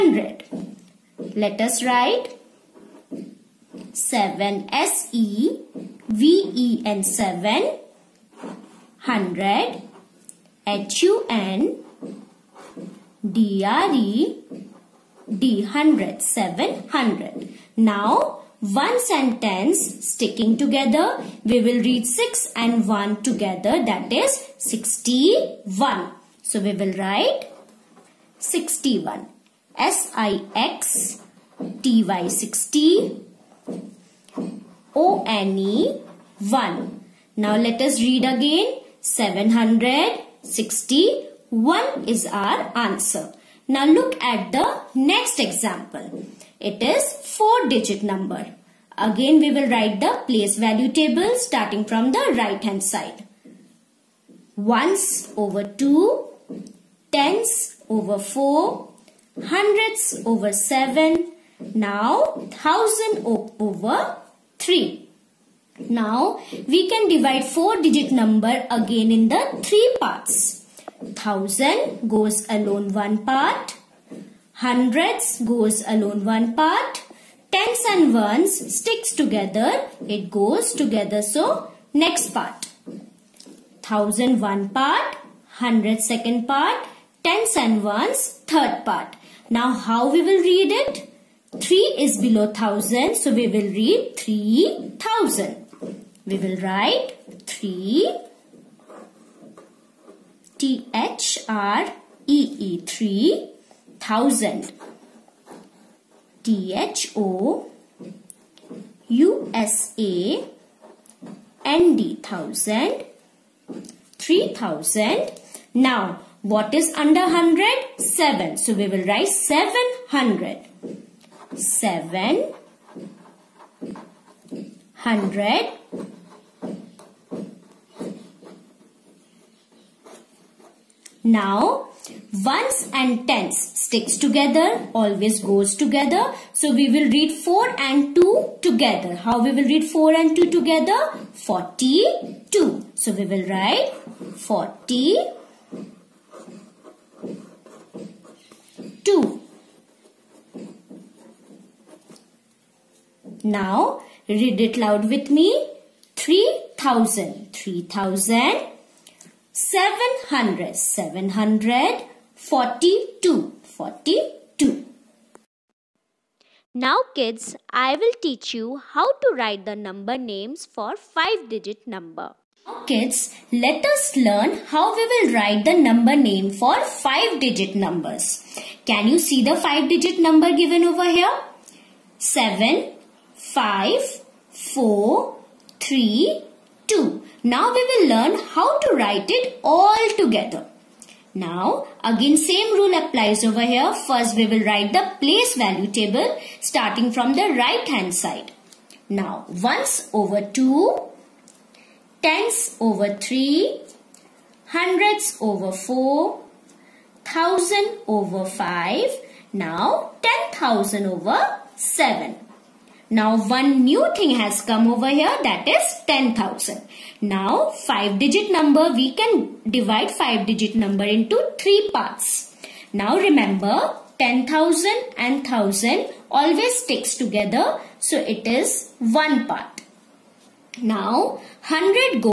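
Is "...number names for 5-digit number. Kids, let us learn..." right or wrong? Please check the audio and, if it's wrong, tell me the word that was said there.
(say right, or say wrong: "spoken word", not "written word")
right.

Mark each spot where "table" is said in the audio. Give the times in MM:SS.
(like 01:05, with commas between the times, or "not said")
00:50, 03:15.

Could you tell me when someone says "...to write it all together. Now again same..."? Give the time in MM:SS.
03:08.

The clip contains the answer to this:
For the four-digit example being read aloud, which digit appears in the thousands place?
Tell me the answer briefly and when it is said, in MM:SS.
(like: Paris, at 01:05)
3, at 01:02.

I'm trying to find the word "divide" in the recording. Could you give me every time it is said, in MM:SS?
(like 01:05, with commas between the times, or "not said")
01:07, 03:39.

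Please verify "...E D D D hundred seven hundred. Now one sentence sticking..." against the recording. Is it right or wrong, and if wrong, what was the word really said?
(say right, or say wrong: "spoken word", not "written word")
right.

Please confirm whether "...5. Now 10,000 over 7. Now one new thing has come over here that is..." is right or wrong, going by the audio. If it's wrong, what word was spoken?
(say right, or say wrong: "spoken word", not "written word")
right.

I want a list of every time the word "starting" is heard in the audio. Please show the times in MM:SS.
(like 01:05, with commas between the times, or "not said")
00:51, 03:16.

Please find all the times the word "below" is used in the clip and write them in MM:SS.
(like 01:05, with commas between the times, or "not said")
01:32.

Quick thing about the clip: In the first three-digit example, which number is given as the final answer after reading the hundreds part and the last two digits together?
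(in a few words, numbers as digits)
761.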